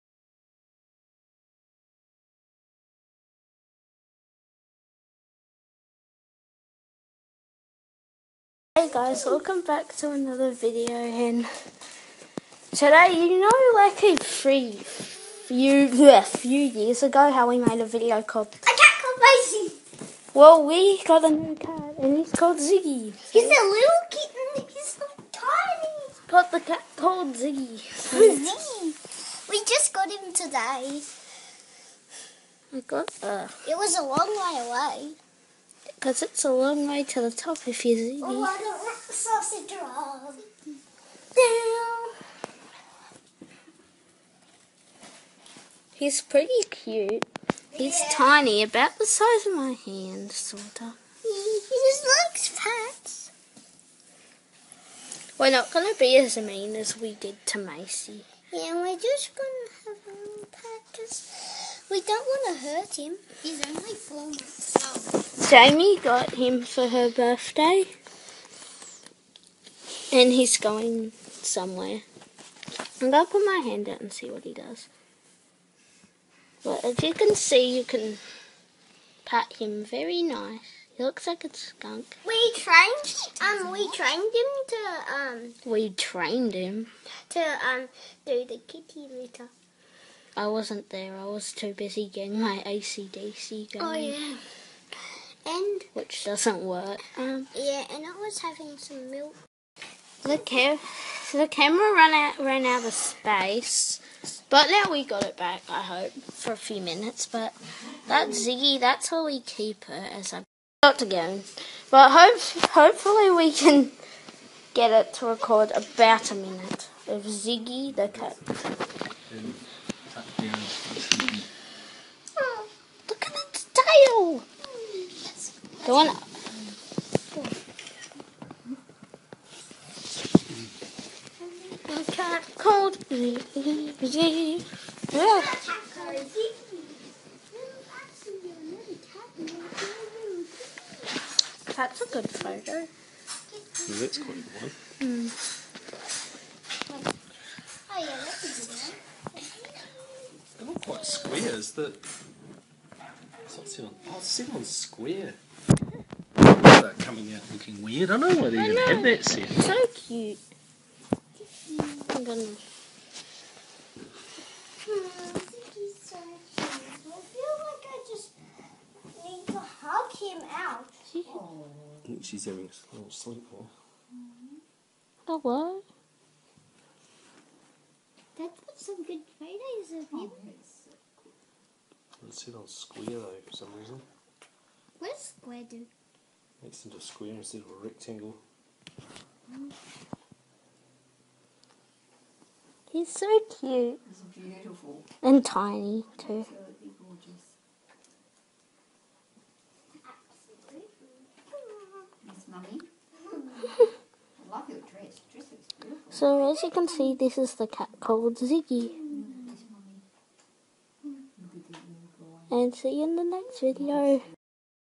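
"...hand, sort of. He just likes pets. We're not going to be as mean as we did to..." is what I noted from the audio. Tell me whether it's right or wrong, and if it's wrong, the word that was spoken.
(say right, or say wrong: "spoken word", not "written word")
right.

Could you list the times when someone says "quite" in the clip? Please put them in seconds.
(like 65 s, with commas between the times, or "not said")
144 s, 150 s.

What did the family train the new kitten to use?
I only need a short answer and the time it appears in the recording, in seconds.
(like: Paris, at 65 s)
The kitty litter, at 88 s.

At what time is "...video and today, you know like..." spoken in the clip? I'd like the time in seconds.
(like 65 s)
10 s.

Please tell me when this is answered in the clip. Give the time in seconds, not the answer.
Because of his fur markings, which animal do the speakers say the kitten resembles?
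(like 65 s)
81 s.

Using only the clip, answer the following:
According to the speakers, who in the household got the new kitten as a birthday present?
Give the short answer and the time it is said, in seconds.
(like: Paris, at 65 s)
Jaimie, at 65 s.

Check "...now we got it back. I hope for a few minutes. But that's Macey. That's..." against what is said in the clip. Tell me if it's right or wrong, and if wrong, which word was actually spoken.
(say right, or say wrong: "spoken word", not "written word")
wrong: "Ziggy", not "Macey".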